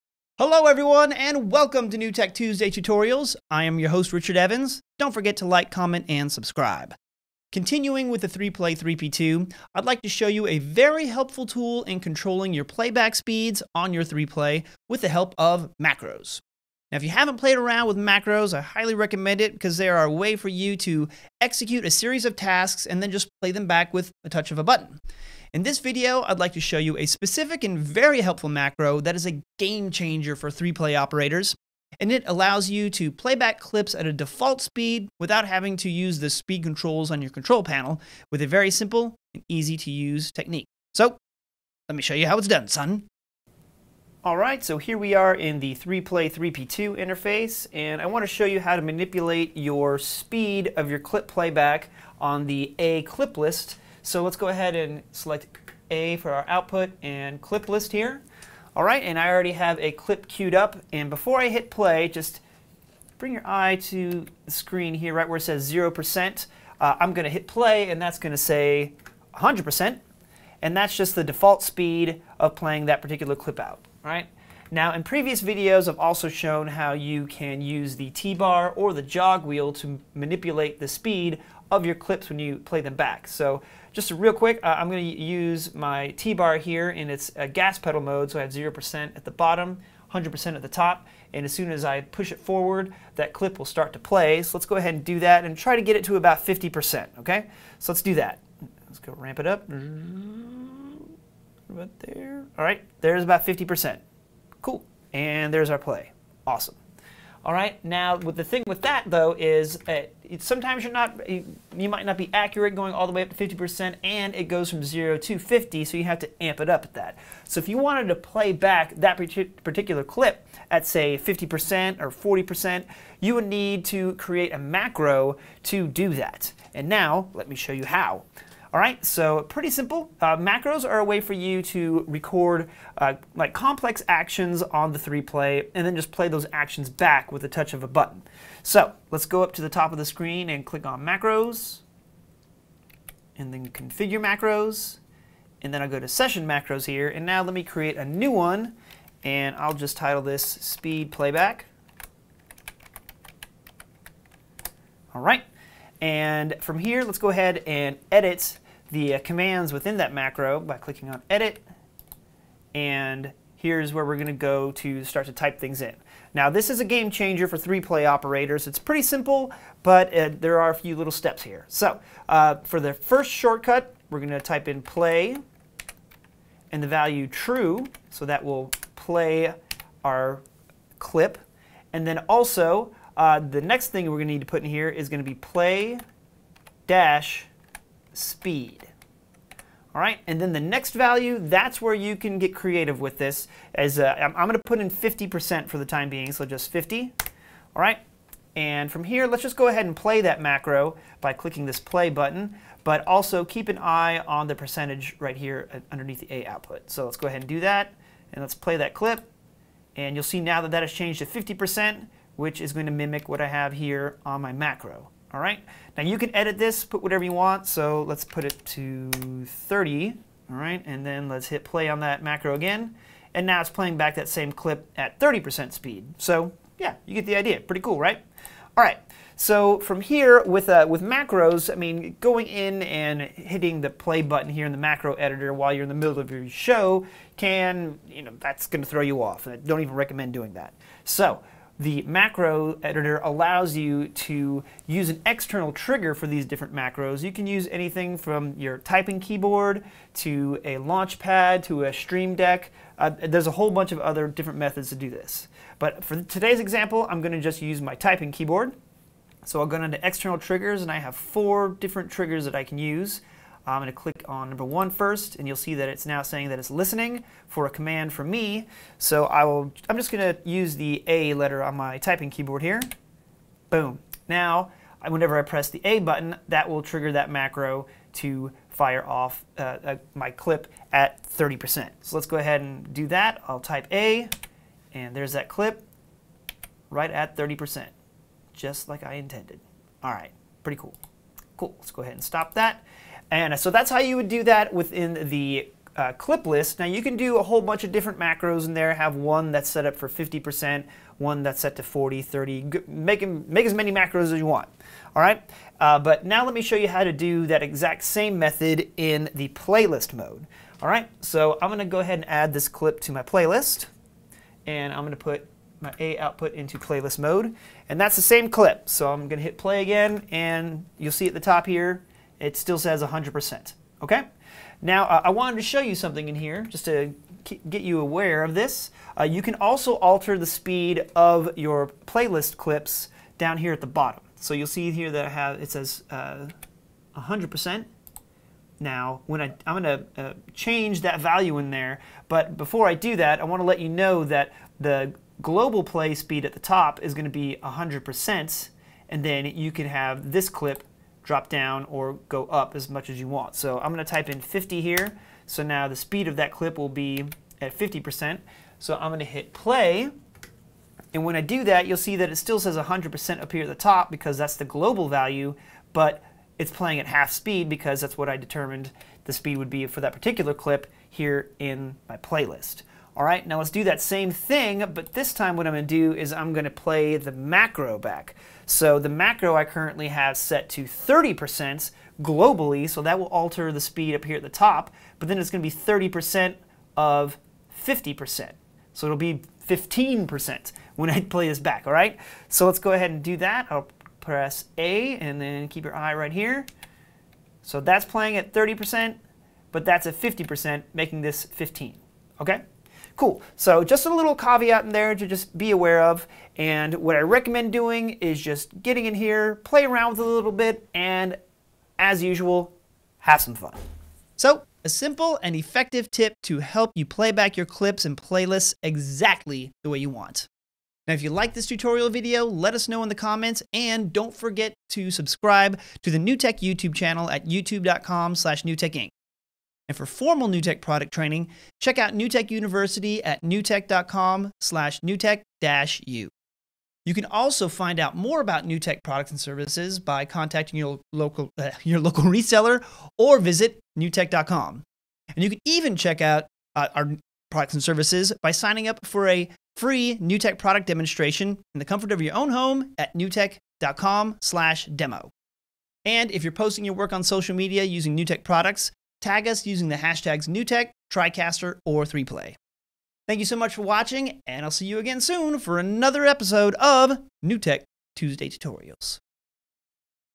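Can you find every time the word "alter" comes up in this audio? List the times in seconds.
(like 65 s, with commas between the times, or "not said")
329 s, 383 s.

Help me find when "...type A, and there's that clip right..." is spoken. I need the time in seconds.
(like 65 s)
283 s.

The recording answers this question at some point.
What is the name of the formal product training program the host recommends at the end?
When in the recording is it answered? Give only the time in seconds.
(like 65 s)
432 s.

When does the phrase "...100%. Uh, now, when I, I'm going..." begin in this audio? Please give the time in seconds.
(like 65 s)
336 s.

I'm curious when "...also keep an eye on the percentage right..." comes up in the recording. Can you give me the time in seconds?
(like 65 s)
203 s.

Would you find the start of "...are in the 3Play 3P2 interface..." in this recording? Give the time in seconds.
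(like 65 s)
45 s.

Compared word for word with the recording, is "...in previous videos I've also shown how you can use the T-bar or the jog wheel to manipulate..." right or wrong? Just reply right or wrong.
right.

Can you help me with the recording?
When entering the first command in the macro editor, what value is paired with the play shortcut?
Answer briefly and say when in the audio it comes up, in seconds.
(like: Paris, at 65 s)
true, at 177 s.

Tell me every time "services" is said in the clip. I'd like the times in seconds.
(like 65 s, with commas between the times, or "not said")
439 s, 447 s.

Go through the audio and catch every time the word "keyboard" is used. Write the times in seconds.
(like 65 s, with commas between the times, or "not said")
249 s, 258 s, 272 s.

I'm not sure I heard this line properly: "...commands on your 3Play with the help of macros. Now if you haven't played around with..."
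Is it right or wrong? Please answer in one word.
wrong.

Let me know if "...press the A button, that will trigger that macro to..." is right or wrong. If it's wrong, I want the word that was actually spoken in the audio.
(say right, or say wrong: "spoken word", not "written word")
right.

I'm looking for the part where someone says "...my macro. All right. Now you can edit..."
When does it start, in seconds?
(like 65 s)
214 s.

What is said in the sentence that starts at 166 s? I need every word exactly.
Now this is a game changer for three play operators.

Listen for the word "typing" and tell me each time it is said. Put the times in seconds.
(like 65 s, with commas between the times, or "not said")
248 s, 257 s, 271 s.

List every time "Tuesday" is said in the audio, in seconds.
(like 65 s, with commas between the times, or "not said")
2 s, 468 s.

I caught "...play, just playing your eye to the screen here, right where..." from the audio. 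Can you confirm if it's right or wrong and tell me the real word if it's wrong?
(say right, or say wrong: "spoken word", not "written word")
wrong: "bring", not "playing".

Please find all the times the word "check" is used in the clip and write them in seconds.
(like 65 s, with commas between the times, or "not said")
431 s, 445 s.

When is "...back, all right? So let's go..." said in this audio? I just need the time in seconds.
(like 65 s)
391 s.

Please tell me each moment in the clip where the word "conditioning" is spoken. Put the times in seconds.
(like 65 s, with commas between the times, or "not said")
not said.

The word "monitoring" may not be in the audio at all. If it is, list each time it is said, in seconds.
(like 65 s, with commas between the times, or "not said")
not said.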